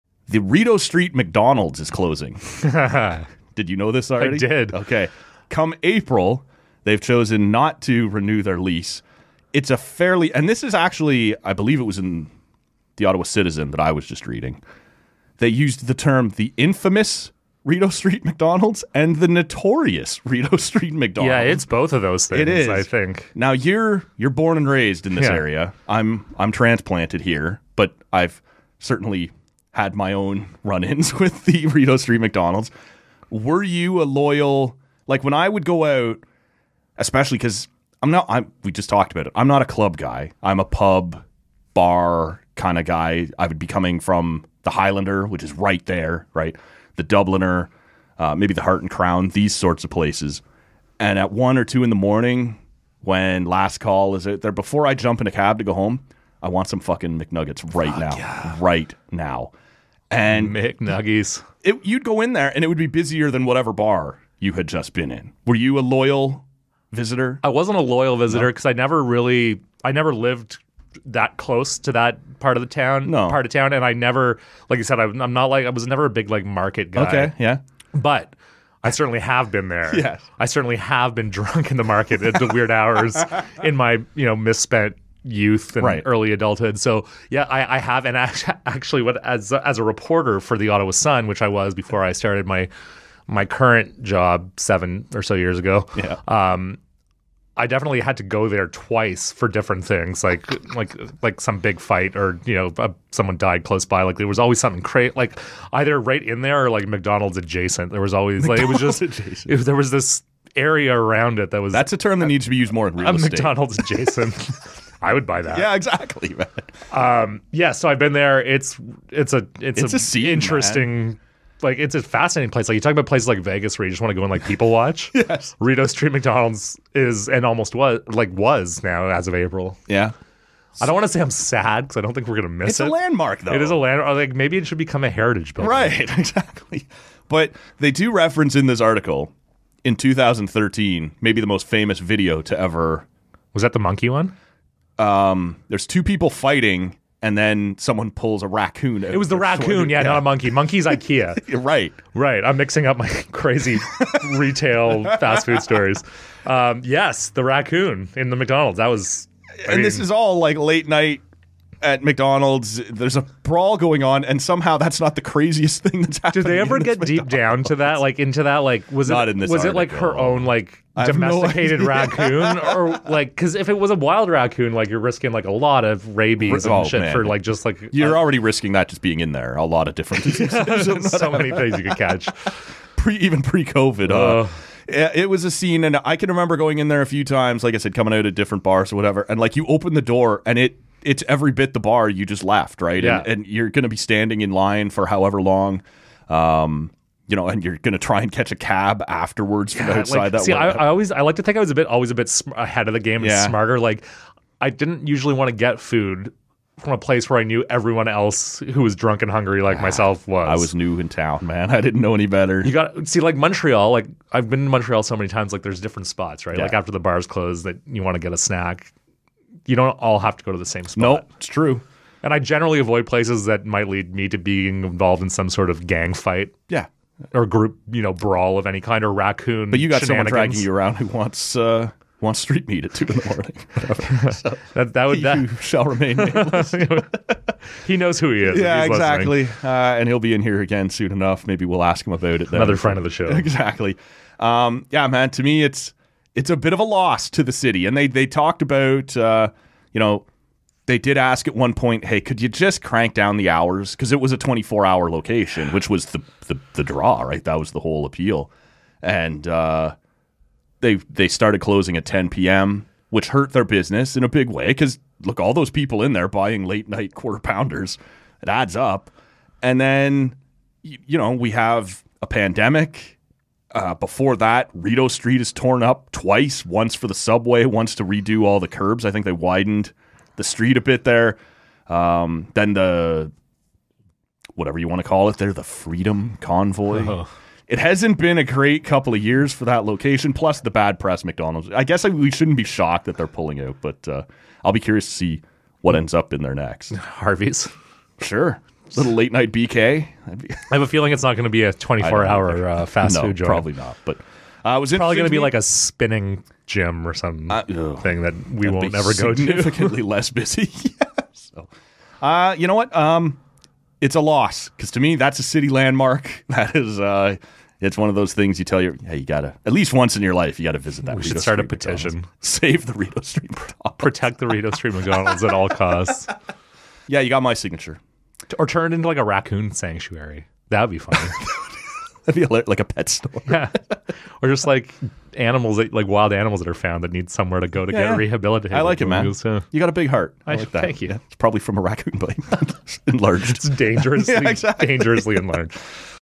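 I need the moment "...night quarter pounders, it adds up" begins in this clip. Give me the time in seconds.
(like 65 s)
266 s.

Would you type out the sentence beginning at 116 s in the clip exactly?
Um, yeah, so I've been there.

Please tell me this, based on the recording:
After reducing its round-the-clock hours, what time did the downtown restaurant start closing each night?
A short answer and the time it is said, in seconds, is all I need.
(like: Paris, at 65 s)
10 p.m., at 262 s.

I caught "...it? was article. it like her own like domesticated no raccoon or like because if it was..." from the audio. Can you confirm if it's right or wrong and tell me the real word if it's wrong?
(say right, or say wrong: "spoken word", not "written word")
right.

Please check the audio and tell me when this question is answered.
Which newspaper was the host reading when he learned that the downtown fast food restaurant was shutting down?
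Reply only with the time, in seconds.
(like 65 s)
13 s.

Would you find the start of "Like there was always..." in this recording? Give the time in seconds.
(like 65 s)
104 s.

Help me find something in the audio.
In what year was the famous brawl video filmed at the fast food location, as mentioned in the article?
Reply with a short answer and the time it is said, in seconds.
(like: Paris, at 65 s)
2013, at 139 s.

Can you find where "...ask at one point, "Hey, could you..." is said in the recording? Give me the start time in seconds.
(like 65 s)
251 s.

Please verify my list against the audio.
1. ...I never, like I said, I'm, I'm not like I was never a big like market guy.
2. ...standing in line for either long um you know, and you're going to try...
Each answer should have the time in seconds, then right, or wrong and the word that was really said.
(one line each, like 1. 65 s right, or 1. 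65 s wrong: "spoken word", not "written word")
1. 73 s right
2. 193 s wrong: "however", not "either".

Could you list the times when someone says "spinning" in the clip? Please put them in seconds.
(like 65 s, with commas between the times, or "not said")
305 s.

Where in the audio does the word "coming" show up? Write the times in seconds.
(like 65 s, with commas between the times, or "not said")
43 s, 187 s.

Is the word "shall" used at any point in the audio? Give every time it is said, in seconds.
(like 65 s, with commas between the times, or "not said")
235 s.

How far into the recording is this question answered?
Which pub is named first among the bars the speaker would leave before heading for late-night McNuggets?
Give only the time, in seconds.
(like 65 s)
44 s.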